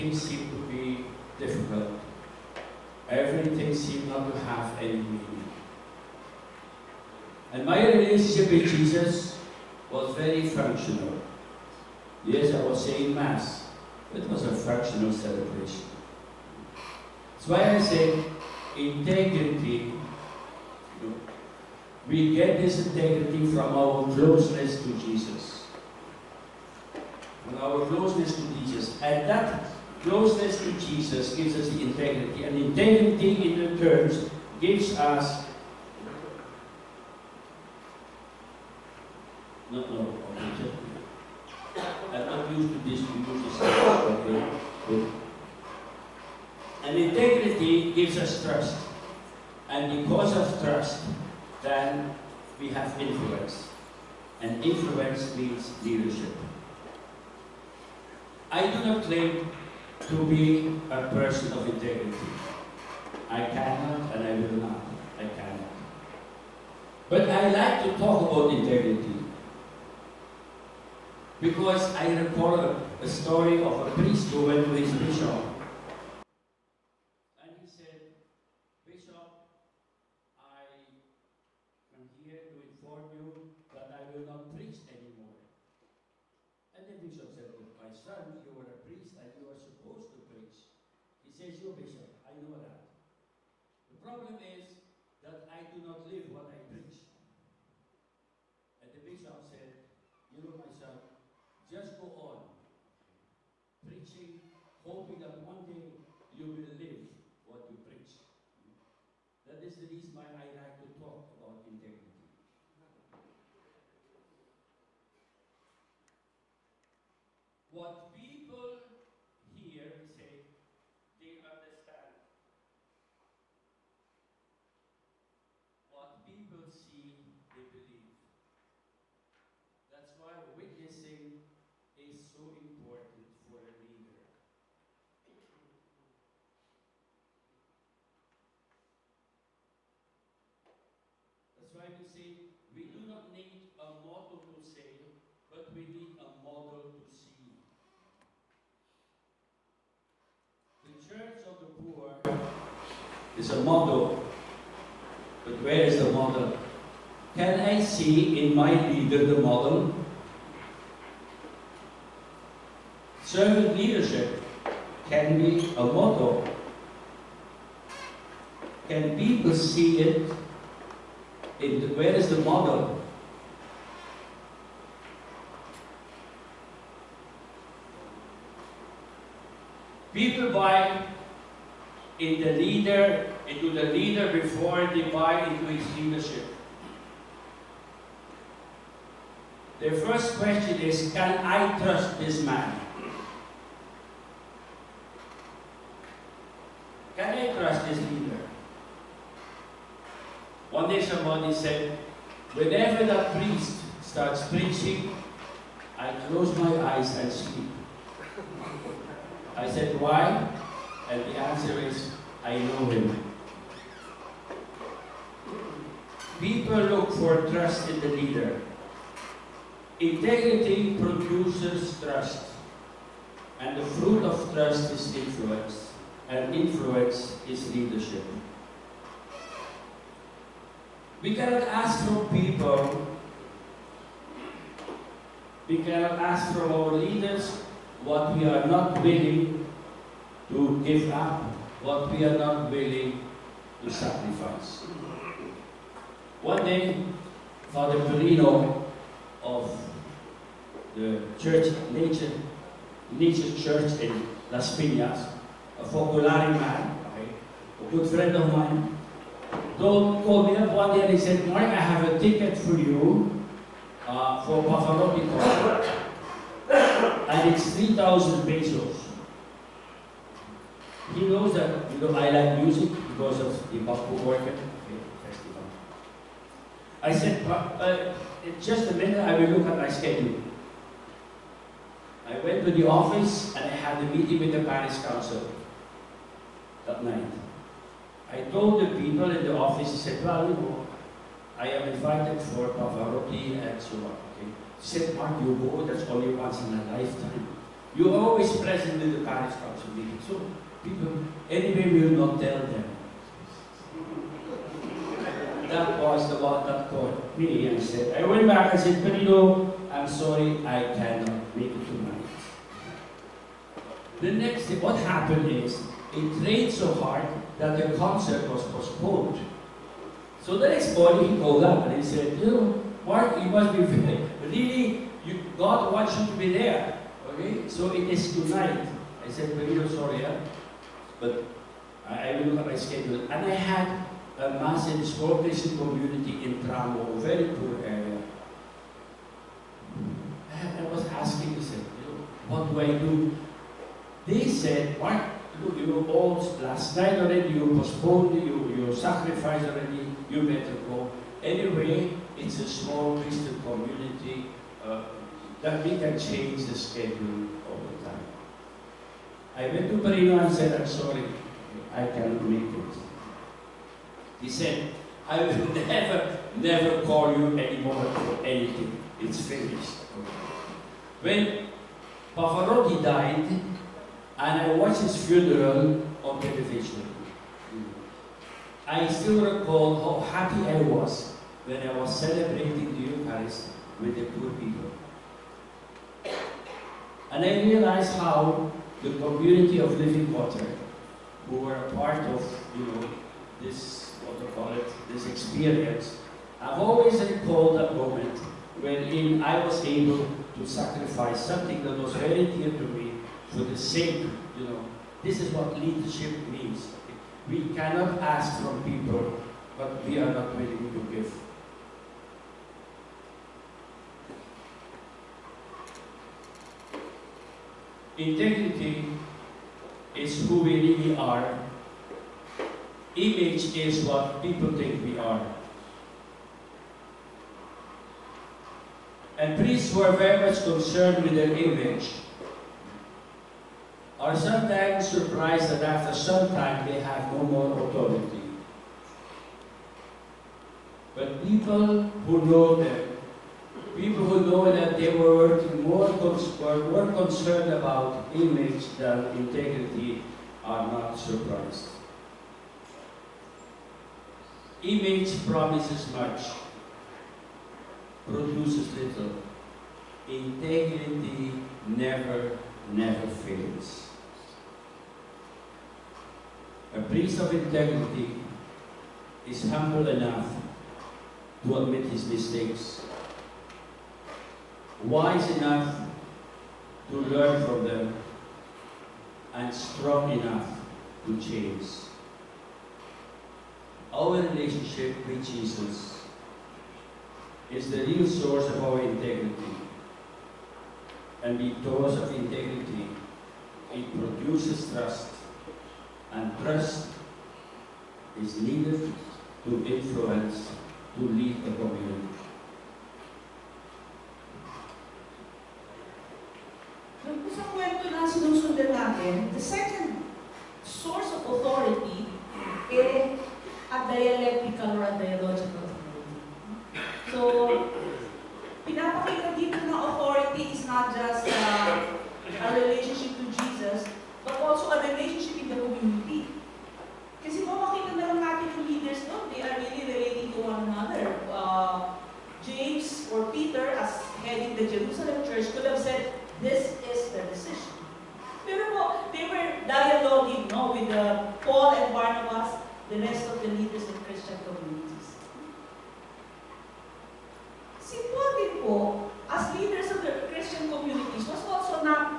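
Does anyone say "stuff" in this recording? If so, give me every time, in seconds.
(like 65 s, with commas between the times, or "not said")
43 s.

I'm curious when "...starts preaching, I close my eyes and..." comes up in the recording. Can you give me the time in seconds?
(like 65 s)
204 s.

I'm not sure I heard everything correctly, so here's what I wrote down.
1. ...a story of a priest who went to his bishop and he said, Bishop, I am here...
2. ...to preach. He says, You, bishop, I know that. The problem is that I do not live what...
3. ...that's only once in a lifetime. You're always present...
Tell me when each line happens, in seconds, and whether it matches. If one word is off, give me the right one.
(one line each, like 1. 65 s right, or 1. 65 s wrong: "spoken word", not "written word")
1. 72 s right
2. 90 s right
3. 295 s right.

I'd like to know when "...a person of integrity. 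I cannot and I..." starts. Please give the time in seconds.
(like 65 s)
60 s.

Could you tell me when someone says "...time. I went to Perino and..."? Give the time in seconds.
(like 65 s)
358 s.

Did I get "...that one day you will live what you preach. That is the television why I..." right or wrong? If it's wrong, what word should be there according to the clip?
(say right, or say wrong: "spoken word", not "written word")
wrong: "reason", not "television".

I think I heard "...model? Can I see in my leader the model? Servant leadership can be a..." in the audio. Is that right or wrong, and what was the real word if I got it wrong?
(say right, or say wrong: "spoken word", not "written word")
right.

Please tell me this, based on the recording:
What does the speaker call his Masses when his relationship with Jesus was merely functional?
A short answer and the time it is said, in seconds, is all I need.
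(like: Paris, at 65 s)
functional celebration, at 14 s.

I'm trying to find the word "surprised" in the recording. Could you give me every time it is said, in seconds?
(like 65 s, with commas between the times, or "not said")
435 s, 451 s.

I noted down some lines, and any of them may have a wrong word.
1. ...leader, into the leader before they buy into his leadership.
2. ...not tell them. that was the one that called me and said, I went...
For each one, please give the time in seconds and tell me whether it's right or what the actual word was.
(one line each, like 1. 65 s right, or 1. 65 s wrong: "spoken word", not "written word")
1. 182 s right
2. 302 s right.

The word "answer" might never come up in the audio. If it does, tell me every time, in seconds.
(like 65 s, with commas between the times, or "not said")
211 s.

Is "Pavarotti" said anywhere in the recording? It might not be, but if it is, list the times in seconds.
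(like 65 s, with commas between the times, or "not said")
264 s, 292 s, 372 s.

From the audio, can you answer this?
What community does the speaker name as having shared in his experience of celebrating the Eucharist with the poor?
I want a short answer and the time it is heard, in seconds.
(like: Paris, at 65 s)
Living Water, at 389 s.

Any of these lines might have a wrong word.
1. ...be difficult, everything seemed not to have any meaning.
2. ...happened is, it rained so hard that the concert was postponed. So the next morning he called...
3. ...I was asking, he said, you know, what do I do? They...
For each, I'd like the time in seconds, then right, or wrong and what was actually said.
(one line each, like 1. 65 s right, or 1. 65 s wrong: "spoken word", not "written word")
1. 0 s right
2. 315 s right
3. 340 s right.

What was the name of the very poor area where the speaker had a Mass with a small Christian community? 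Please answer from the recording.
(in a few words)
Tramo.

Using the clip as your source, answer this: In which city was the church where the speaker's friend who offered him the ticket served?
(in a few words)
Las Piñas.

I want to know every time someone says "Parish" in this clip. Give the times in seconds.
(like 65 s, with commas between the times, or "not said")
284 s, 299 s.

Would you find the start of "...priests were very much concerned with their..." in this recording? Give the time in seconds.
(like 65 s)
429 s.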